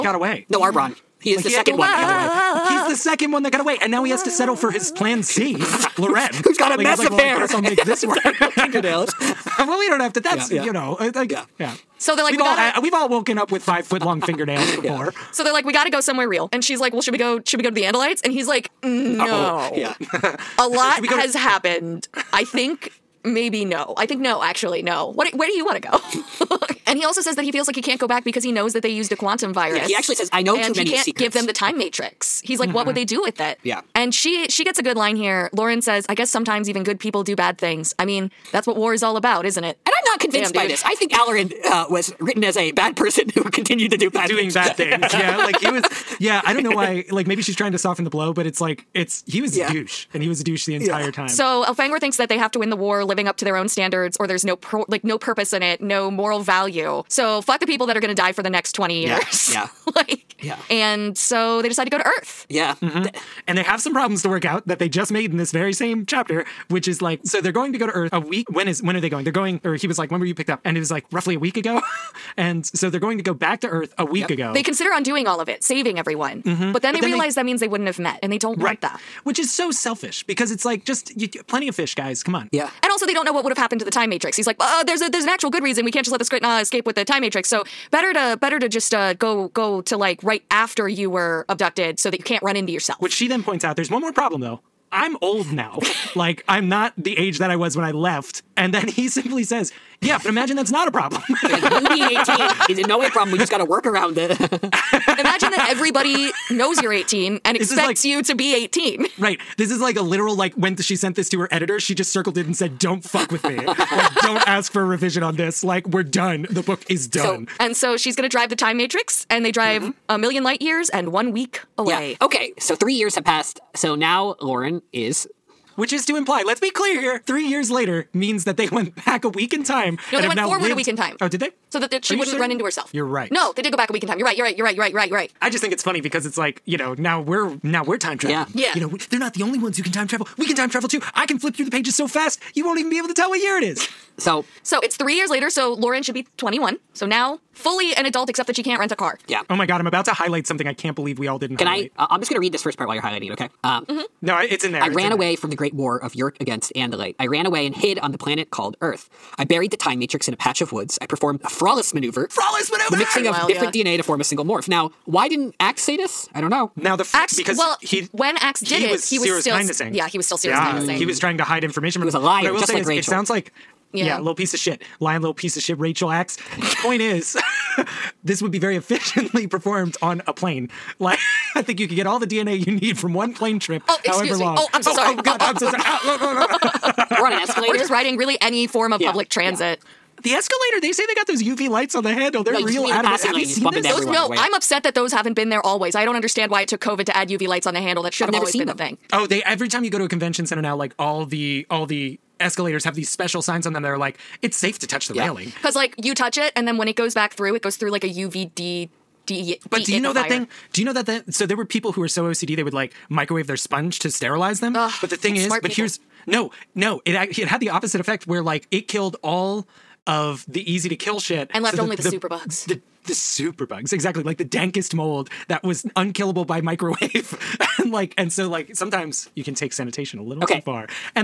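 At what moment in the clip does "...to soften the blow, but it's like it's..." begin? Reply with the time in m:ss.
0:47.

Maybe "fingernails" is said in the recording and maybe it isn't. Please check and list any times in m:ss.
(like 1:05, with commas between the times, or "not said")
0:08, 0:14.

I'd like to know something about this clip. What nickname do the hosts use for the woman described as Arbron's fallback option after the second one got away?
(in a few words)
plan C.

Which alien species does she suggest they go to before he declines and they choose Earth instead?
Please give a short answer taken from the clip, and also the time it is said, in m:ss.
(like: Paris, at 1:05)
Andalites, at 0:17.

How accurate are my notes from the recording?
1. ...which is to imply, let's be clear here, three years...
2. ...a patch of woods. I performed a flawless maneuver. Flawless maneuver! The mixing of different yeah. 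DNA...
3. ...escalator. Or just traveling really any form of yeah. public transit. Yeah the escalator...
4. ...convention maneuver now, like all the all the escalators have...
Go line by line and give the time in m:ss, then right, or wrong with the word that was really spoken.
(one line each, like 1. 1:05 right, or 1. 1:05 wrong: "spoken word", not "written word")
1. 2:05 right
2. 2:40 right
3. 3:07 wrong: "riding", not "traveling"
4. 3:20 wrong: "center", not "maneuver".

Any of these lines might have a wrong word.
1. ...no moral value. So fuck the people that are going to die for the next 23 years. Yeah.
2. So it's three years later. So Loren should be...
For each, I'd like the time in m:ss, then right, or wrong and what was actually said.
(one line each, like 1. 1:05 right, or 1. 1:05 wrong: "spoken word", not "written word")
1. 0:55 wrong: "20", not "23"
2. 2:24 right.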